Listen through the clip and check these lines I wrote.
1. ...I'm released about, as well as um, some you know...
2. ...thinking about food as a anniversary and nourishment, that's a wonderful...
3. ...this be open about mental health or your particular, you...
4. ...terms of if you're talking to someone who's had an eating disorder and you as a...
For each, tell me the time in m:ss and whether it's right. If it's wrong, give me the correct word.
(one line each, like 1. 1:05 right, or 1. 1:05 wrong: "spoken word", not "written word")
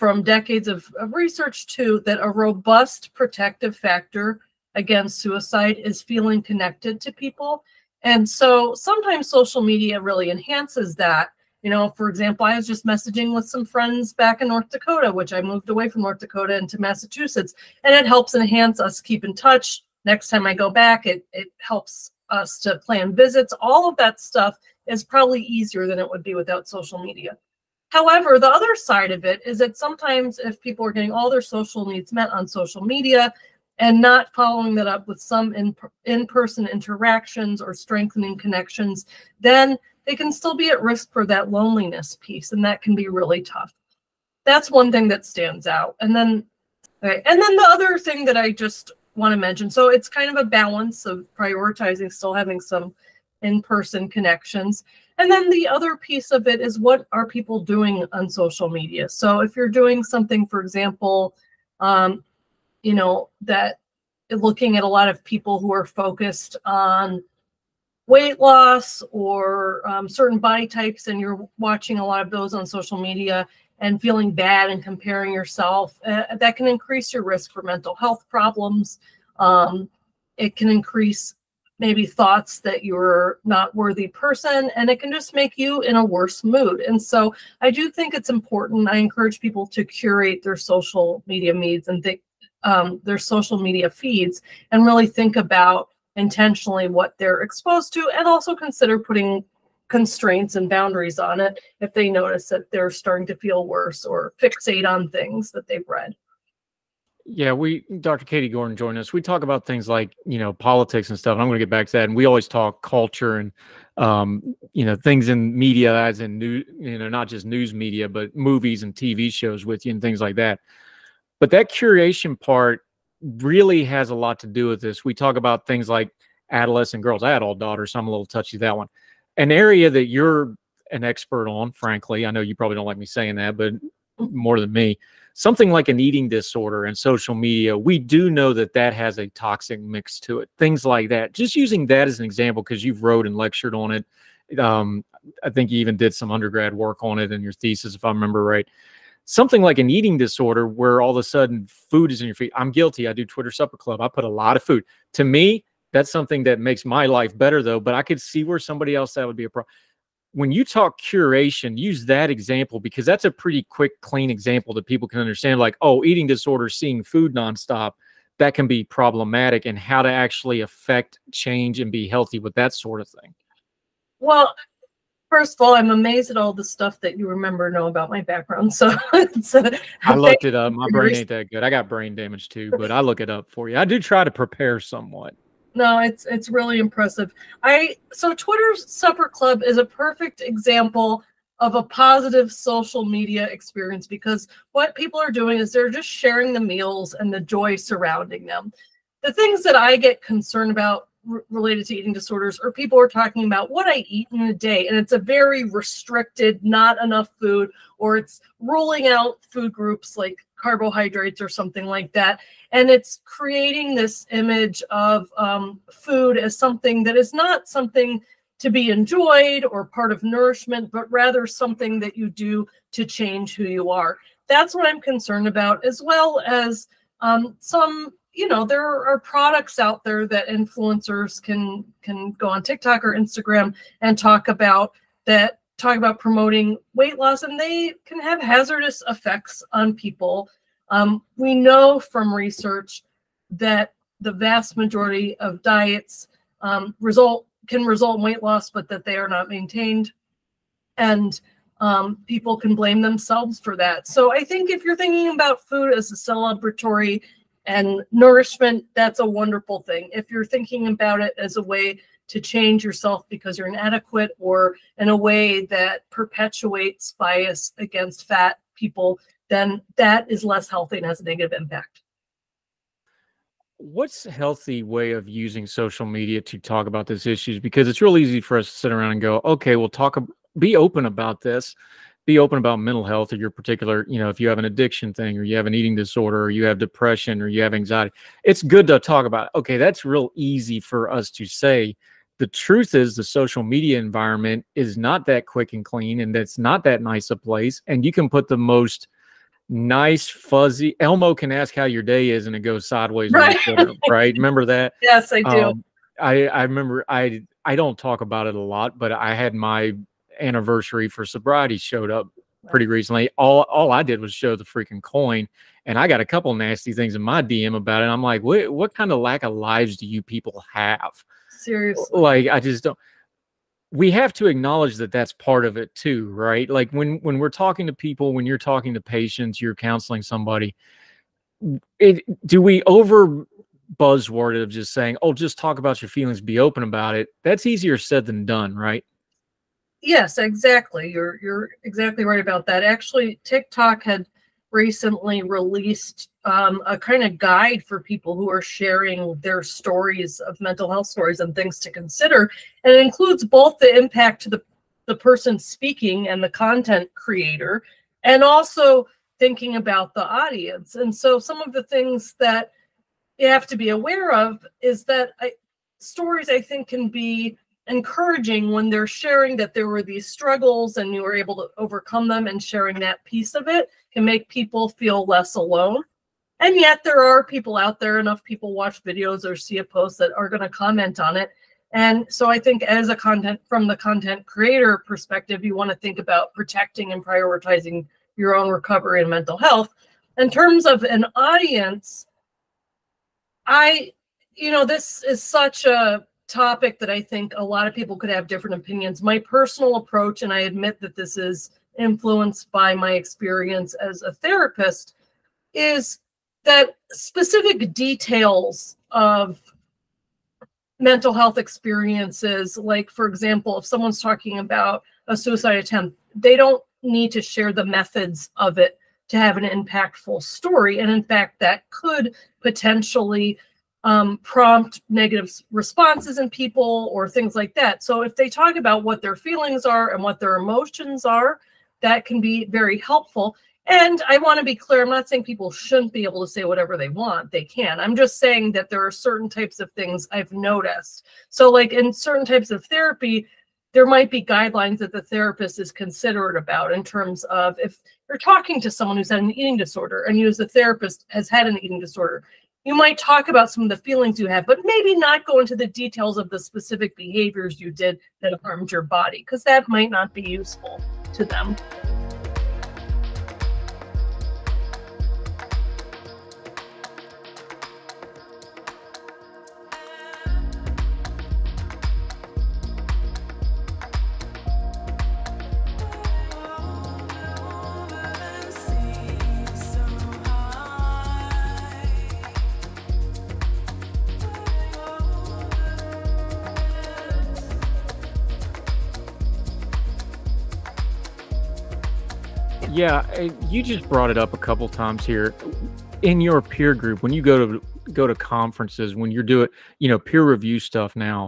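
1. 3:44 wrong: "concerned", not "released"
2. 4:14 wrong: "celebratory", not "anniversary"
3. 4:41 right
4. 7:27 right.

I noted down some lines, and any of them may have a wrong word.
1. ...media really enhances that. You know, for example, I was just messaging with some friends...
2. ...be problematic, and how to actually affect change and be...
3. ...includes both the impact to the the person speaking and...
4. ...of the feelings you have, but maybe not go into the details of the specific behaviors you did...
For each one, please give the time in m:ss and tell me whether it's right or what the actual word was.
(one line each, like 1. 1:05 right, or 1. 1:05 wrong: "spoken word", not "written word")
1. 0:09 right
2. 2:48 right
3. 5:52 right
4. 7:33 right.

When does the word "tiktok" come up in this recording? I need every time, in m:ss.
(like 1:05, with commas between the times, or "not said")
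3:52, 5:43.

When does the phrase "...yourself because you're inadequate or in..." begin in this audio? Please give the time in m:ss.
4:22.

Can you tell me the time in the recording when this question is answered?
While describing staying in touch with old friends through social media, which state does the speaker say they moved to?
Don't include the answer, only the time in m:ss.
0:16.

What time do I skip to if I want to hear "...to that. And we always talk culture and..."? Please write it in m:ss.
1:51.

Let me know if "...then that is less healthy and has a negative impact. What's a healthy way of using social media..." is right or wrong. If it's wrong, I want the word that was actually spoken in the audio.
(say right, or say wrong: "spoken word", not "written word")
right.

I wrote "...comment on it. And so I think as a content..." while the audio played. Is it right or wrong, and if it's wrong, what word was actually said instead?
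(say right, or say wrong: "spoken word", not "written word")
right.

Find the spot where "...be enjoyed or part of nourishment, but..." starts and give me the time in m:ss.
3:38.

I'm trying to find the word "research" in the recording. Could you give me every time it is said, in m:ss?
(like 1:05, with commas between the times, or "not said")
0:01, 4:02.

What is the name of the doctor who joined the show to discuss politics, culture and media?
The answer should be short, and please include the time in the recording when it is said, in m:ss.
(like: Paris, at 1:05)
Katie Gordon, at 1:48.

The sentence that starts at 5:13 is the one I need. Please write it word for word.
All all I did was show the freaking coin, and I got a couple nasty things in my DM about it.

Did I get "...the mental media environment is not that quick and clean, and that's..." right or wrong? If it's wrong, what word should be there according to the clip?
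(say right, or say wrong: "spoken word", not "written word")
wrong: "social", not "mental".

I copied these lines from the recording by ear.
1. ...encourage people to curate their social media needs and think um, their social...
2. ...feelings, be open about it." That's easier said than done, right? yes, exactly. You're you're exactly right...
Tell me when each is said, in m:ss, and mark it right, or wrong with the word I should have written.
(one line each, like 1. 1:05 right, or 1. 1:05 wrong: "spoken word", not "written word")
1. 1:28 right
2. 5:36 right.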